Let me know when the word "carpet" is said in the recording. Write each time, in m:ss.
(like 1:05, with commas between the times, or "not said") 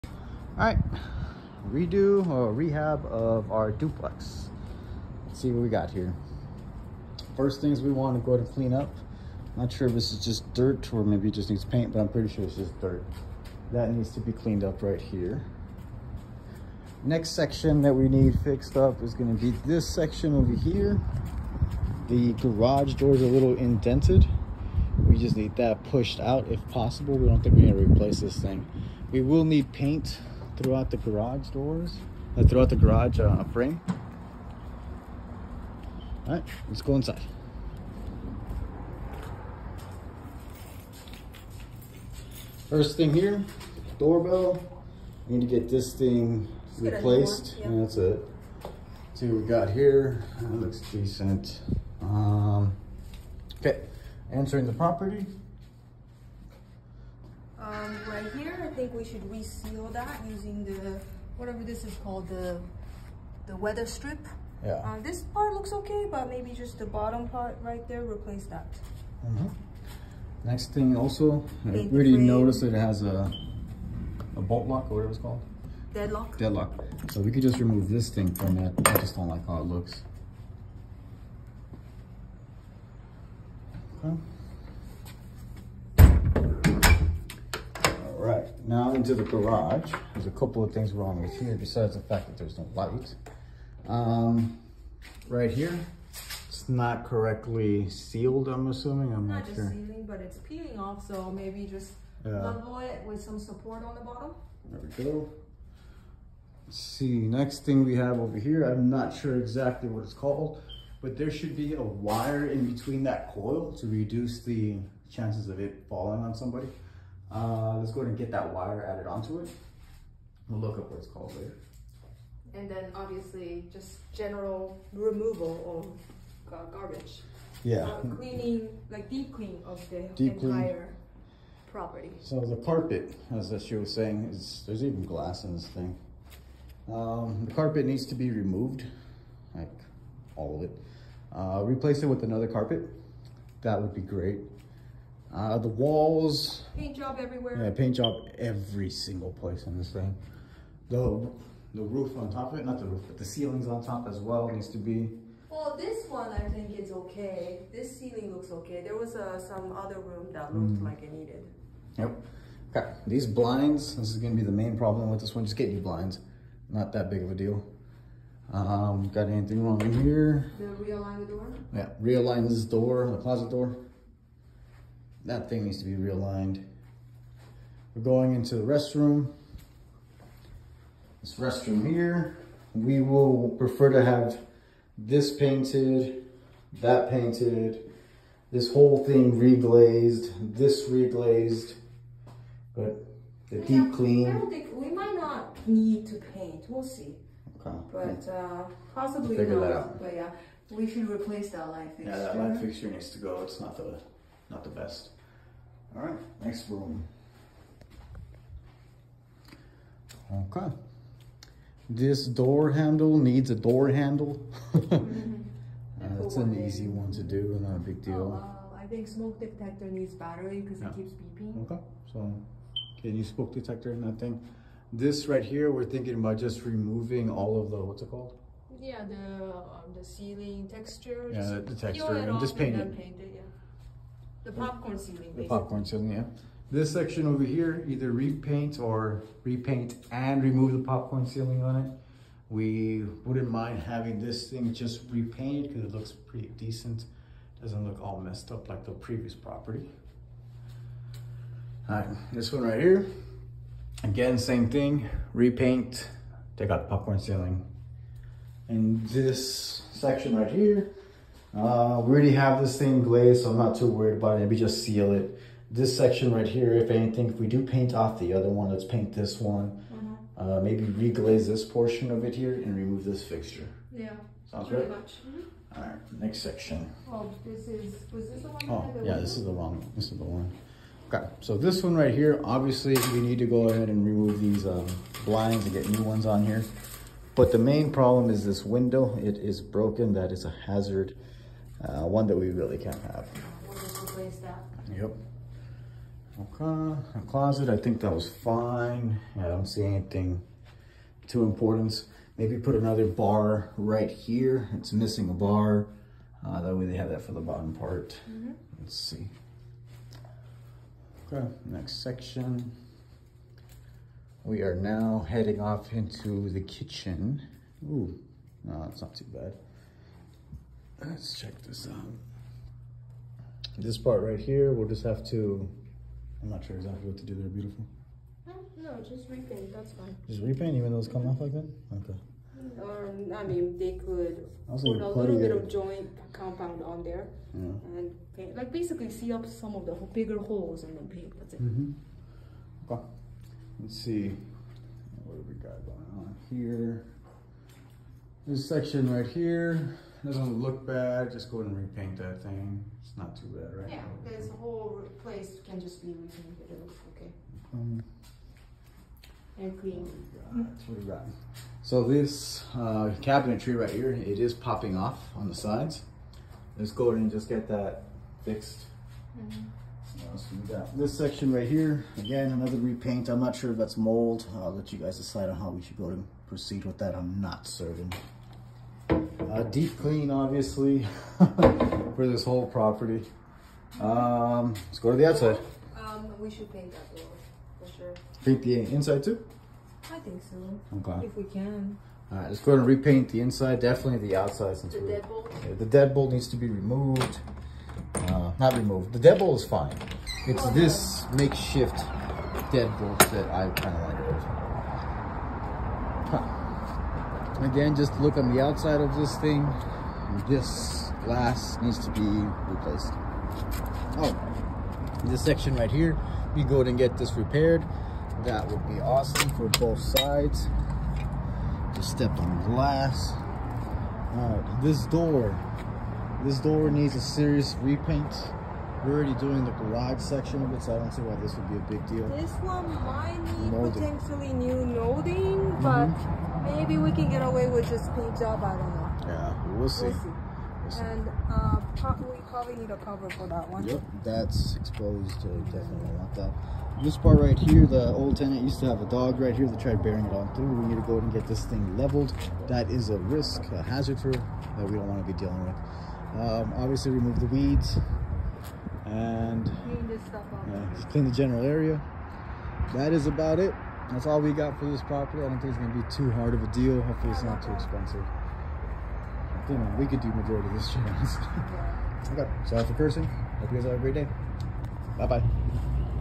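2:12, 2:17, 2:22.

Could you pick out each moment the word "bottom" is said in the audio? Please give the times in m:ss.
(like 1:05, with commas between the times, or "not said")
1:06, 1:44, 5:07.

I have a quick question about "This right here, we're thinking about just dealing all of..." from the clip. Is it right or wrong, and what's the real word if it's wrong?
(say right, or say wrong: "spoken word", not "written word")
wrong: "removing", not "dealing".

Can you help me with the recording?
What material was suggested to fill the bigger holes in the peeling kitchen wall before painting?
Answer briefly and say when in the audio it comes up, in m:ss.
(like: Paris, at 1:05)
joint compound, at 5:35.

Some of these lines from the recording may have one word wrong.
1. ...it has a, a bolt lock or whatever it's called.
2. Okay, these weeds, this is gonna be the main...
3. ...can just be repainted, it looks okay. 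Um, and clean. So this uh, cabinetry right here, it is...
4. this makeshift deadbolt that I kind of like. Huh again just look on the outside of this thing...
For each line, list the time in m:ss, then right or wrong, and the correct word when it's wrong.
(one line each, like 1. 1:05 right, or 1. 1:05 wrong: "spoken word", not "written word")
1. 1:12 right
2. 2:42 wrong: "blinds", not "weeds"
3. 5:55 right
4. 6:40 right.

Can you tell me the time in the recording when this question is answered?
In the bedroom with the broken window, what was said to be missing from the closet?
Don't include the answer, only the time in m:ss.
5:05.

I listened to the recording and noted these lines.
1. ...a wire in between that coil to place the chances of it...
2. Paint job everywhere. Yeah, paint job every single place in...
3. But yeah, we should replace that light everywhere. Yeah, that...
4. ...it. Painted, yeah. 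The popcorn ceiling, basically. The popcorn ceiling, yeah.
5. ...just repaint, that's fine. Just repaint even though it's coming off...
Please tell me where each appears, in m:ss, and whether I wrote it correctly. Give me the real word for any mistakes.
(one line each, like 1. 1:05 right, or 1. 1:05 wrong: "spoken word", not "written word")
1. 1:51 wrong: "reduce", not "place"
2. 2:26 right
3. 3:20 wrong: "fixture", not "everywhere"
4. 3:52 right
5. 5:29 right.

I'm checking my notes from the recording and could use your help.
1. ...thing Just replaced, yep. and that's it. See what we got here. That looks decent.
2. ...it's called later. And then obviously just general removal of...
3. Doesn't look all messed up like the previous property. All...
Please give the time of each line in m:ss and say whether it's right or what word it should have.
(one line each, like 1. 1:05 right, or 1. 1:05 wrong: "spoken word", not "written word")
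1. 0:45 right
2. 2:00 right
3. 4:07 right.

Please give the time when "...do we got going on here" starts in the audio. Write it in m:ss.
5:45.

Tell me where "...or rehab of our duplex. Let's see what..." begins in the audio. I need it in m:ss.
0:02.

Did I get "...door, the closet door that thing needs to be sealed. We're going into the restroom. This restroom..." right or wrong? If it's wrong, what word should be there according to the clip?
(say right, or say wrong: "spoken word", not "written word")
wrong: "realigned", not "sealed".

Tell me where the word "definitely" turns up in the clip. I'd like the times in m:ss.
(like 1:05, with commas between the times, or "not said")
6:33, 7:25.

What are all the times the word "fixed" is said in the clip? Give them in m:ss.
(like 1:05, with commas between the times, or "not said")
0:18, 6:08.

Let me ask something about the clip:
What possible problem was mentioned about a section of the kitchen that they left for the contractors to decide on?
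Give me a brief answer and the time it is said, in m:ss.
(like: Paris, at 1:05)
mold, at 6:13.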